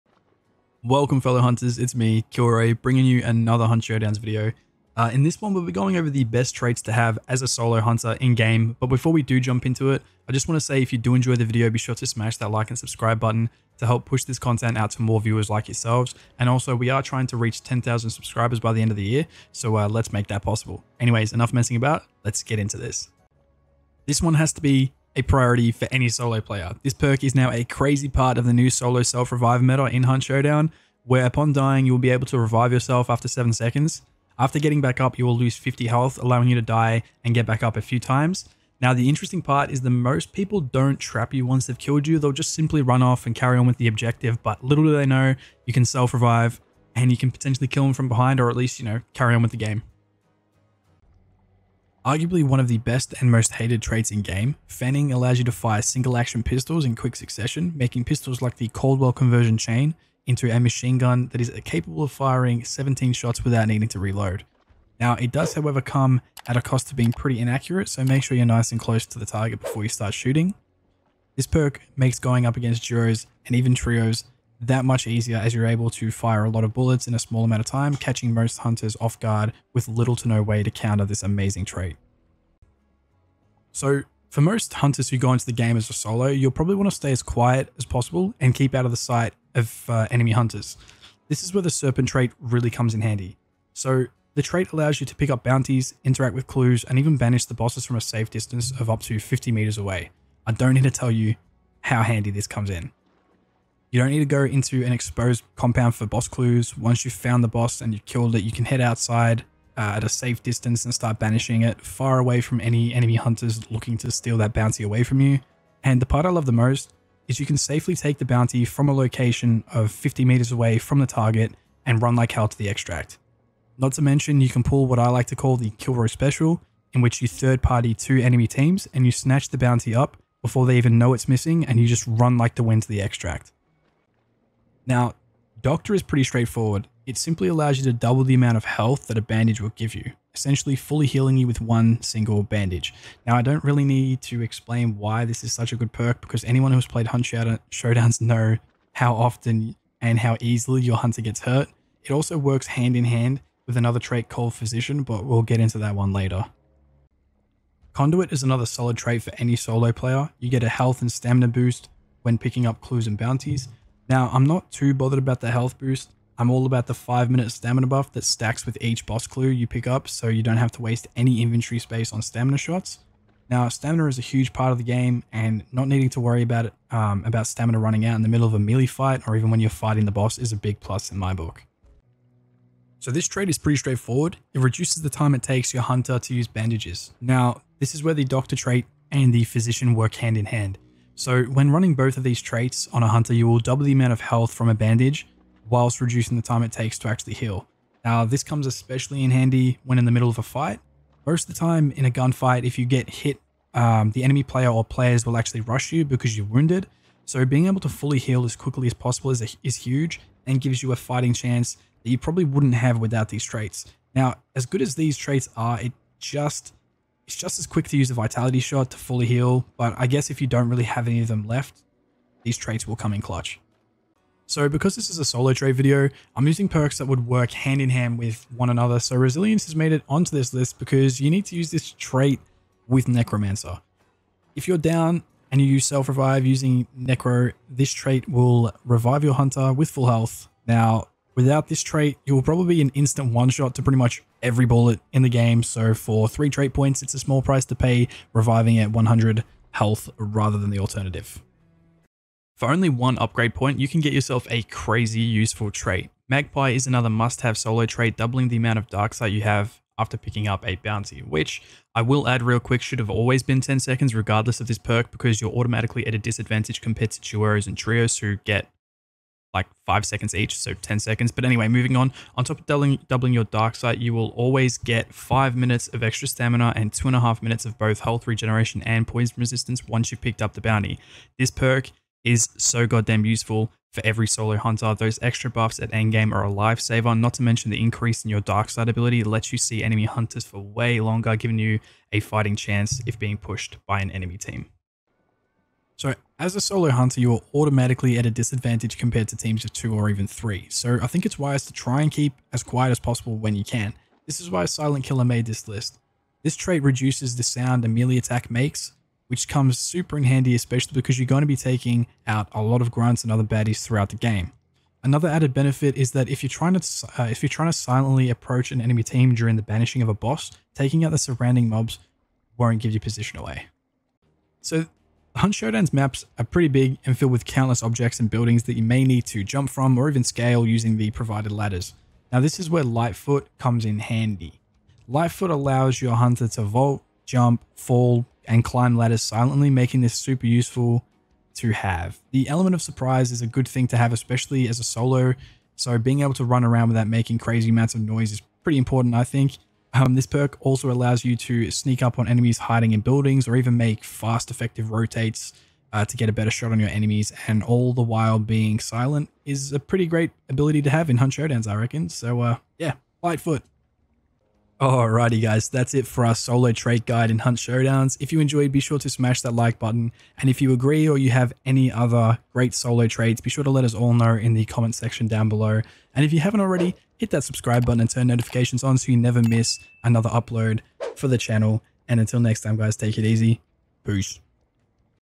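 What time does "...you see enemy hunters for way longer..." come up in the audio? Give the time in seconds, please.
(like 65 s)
289 s.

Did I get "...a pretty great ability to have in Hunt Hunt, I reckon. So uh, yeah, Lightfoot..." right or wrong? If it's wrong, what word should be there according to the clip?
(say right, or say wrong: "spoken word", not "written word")
wrong: "Showdowns", not "Hunt".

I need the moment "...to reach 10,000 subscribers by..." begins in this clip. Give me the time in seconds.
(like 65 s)
17 s.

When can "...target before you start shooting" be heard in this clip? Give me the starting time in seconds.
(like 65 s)
69 s.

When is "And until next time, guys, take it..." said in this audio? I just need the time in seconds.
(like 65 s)
382 s.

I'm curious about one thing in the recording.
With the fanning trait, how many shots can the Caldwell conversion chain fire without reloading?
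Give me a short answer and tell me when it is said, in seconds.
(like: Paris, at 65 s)
17, at 62 s.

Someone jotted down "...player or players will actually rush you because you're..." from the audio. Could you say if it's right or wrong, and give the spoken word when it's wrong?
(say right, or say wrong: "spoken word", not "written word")
right.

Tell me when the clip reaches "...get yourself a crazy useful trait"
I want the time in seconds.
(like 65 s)
254 s.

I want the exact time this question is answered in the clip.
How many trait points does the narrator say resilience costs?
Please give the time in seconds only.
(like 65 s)
246 s.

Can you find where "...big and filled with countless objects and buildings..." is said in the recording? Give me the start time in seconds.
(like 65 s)
326 s.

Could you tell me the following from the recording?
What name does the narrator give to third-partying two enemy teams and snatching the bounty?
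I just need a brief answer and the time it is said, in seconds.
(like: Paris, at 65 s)
the row Special, at 125 s.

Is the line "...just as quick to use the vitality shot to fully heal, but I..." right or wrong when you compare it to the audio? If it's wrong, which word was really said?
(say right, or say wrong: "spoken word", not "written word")
right.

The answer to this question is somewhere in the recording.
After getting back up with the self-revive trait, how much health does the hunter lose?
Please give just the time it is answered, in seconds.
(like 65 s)
35 s.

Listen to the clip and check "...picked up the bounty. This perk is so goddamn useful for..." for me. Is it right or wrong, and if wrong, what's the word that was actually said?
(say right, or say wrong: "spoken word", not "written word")
right.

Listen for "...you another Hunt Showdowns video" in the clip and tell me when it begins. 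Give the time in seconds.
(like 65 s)
3 s.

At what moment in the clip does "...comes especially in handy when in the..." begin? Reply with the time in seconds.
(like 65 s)
198 s.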